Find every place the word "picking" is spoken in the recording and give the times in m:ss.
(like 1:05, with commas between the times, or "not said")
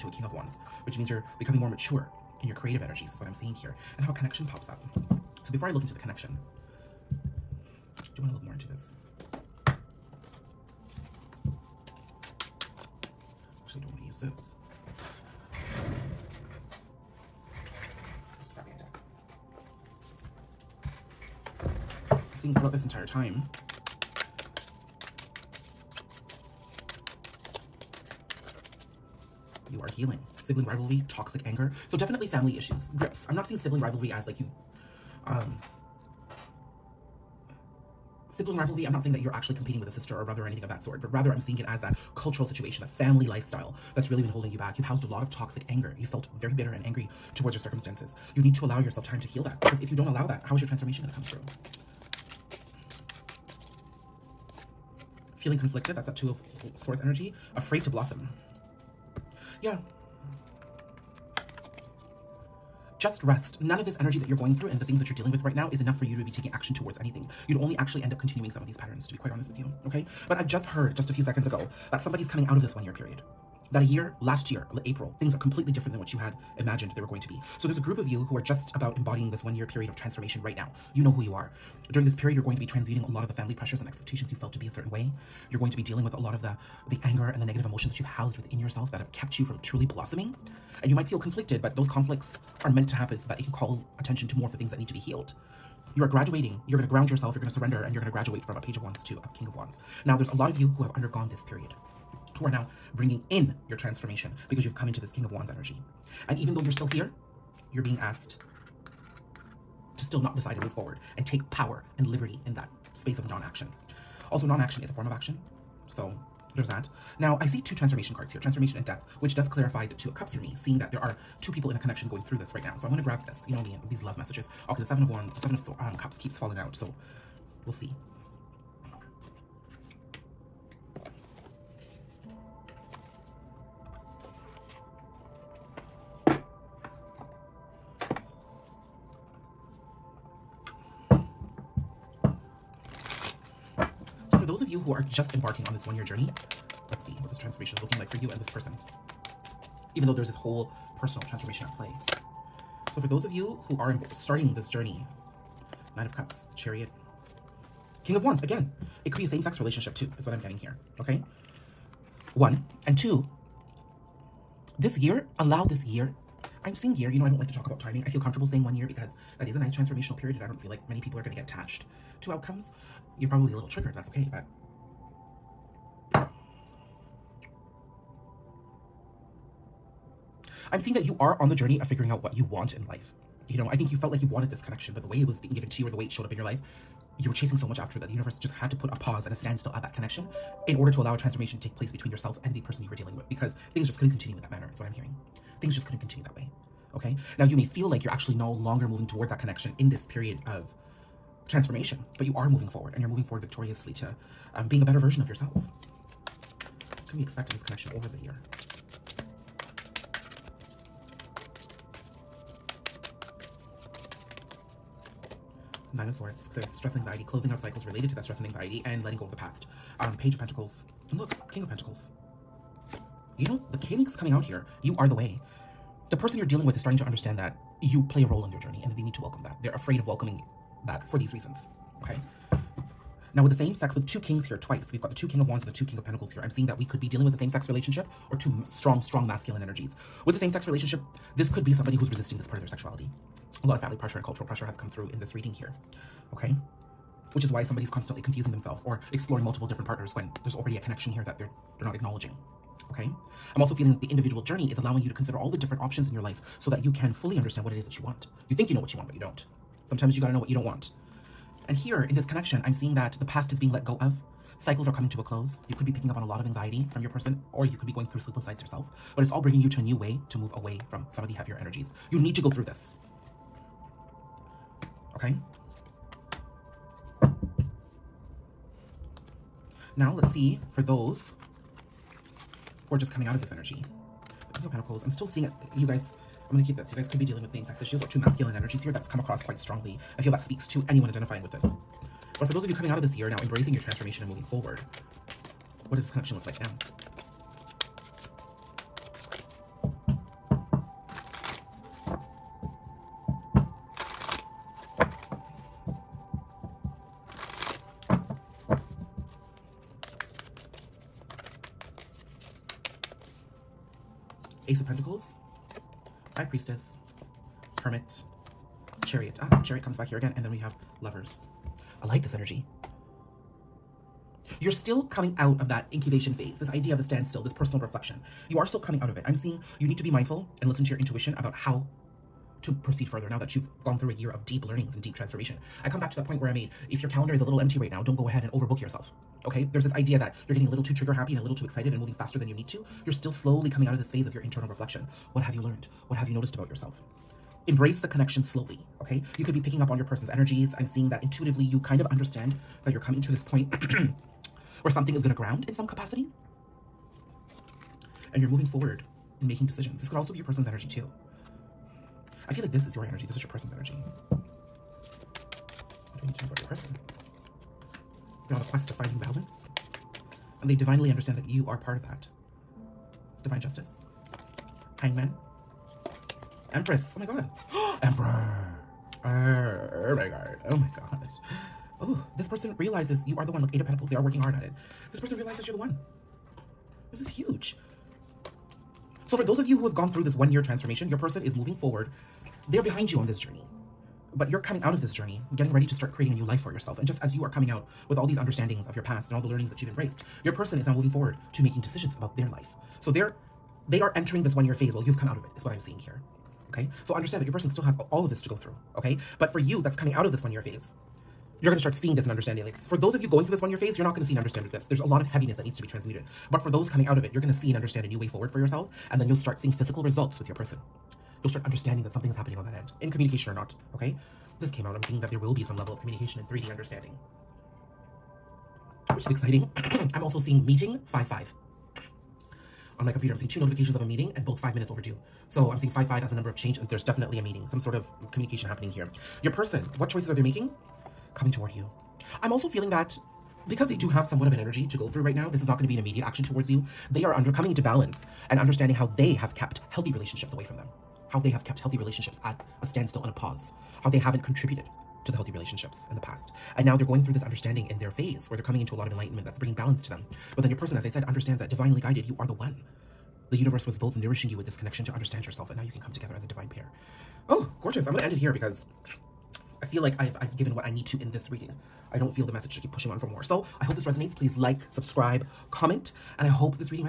4:25, 5:49.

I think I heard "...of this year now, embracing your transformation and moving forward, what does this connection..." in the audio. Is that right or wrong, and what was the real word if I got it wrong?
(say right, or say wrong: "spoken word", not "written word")
right.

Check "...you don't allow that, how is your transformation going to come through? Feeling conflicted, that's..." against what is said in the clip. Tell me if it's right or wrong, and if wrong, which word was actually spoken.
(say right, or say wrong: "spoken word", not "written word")
right.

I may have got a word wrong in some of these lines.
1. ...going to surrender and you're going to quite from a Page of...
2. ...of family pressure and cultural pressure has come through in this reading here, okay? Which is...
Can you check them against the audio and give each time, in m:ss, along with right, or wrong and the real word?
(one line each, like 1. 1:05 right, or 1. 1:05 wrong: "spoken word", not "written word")
1. 1:37 wrong: "graduate", not "quite"
2. 4:03 right.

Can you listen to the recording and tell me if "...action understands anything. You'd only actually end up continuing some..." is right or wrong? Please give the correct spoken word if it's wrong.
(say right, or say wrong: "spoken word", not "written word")
wrong: "towards", not "understands".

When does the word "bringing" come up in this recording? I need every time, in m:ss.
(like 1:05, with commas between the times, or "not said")
1:42, 4:29, 7:39.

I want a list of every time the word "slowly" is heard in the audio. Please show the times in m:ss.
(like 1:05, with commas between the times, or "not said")
5:43, 5:48.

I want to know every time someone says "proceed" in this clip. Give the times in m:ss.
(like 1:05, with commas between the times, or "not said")
5:32.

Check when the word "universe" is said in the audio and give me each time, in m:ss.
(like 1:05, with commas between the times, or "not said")
3:08, 7:43.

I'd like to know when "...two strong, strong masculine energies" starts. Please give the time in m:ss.
3:58.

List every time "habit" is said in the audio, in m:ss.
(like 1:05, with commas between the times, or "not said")
not said.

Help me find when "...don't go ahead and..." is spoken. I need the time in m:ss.
5:38.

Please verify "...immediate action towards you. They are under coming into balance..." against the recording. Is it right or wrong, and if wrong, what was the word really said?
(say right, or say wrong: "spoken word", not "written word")
right.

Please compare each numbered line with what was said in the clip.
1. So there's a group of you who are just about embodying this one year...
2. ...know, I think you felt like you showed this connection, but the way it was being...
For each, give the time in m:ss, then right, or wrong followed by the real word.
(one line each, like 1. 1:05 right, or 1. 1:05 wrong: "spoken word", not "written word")
1. 1:17 right
2. 3:03 wrong: "wanted", not "showed".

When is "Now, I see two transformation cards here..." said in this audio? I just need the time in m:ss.
1:57.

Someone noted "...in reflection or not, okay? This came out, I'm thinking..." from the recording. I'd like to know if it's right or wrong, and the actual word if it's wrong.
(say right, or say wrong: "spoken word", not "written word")
wrong: "communication", not "reflection".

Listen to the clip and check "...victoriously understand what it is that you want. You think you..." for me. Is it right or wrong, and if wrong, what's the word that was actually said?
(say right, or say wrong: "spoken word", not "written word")
wrong: "fully", not "victoriously".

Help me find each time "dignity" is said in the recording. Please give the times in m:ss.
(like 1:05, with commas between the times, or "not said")
not said.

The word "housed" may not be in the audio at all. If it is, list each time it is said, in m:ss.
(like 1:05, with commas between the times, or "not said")
0:44, 1:28.